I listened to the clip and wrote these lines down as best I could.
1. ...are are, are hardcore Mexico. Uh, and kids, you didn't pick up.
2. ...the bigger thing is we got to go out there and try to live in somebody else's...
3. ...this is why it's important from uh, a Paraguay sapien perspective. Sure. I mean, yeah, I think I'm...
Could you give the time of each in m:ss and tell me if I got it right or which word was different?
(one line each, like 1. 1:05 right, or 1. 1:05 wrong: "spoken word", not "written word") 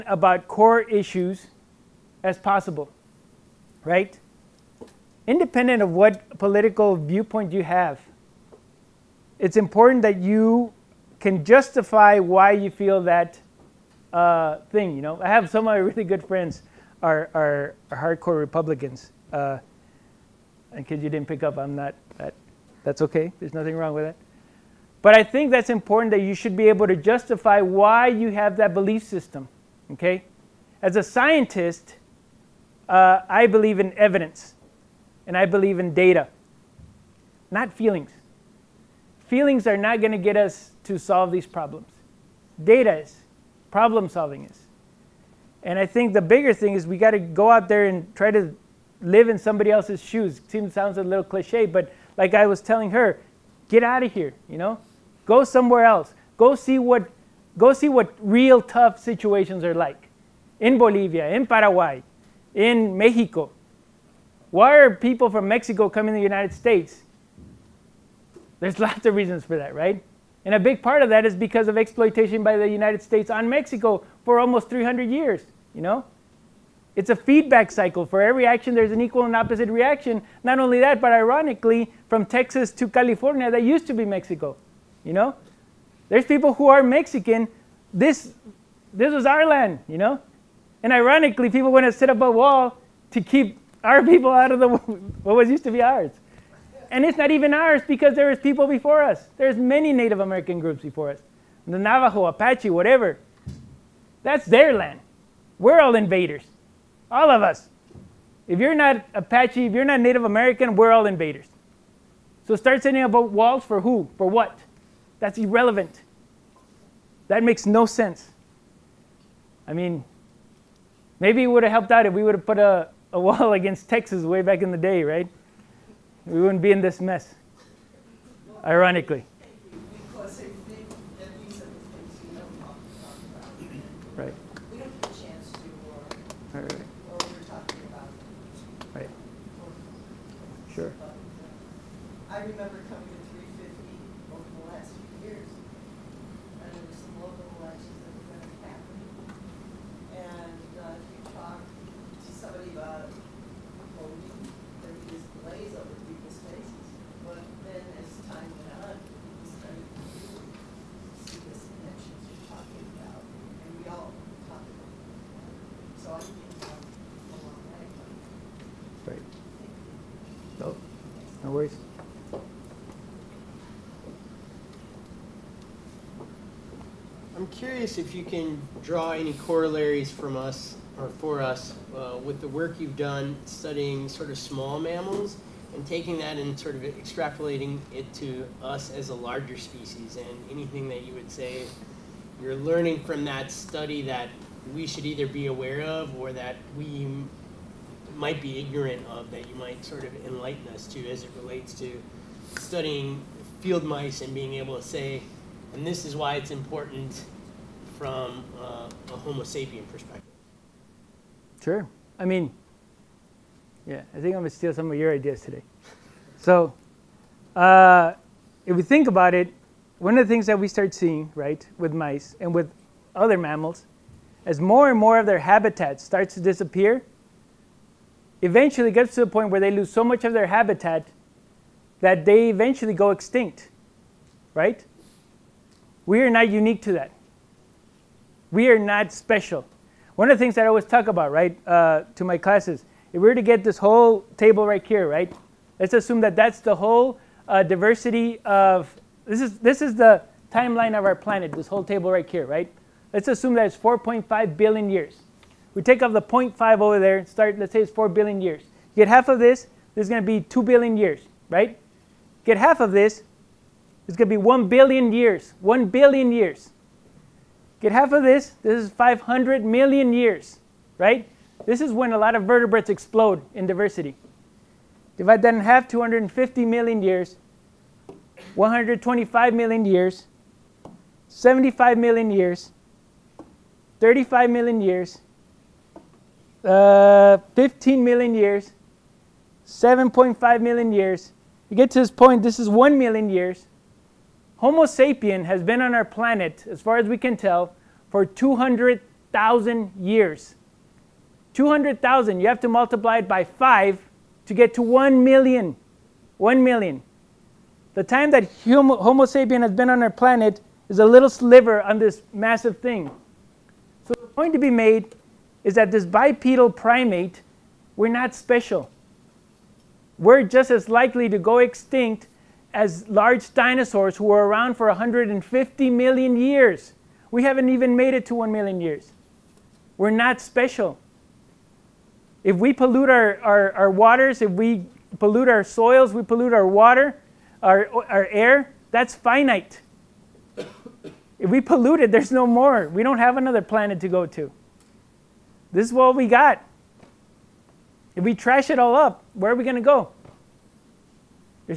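1. 0:17 wrong: "Republicans", not "Mexico"
2. 0:46 right
3. 3:25 wrong: "Homo", not "Paraguay".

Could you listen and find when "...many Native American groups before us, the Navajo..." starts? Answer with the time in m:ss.
1:39.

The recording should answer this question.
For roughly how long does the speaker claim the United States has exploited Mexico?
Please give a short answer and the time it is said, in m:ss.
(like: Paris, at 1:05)
300 years, at 1:14.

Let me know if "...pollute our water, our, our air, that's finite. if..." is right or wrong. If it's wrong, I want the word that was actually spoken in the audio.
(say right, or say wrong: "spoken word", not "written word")
right.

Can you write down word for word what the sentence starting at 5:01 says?
200,000, you have to multiply it by 5 to get to 1 million.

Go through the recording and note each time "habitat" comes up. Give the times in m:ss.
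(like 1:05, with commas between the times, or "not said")
3:45, 3:50.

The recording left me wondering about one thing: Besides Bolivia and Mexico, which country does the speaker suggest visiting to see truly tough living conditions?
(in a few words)
Paraguay.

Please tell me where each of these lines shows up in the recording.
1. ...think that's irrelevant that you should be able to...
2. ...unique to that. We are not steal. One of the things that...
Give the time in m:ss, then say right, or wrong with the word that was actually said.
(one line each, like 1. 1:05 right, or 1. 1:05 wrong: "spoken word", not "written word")
1. 0:25 wrong: "important", not "irrelevant"
2. 3:56 wrong: "special", not "steal".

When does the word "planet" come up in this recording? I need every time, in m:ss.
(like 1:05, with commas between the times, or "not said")
4:11, 4:56, 5:10, 5:43.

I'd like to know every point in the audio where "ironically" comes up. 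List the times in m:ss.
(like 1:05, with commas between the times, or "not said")
1:21, 1:30, 2:08.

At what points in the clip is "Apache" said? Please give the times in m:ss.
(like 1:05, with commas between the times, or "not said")
1:42, 1:49.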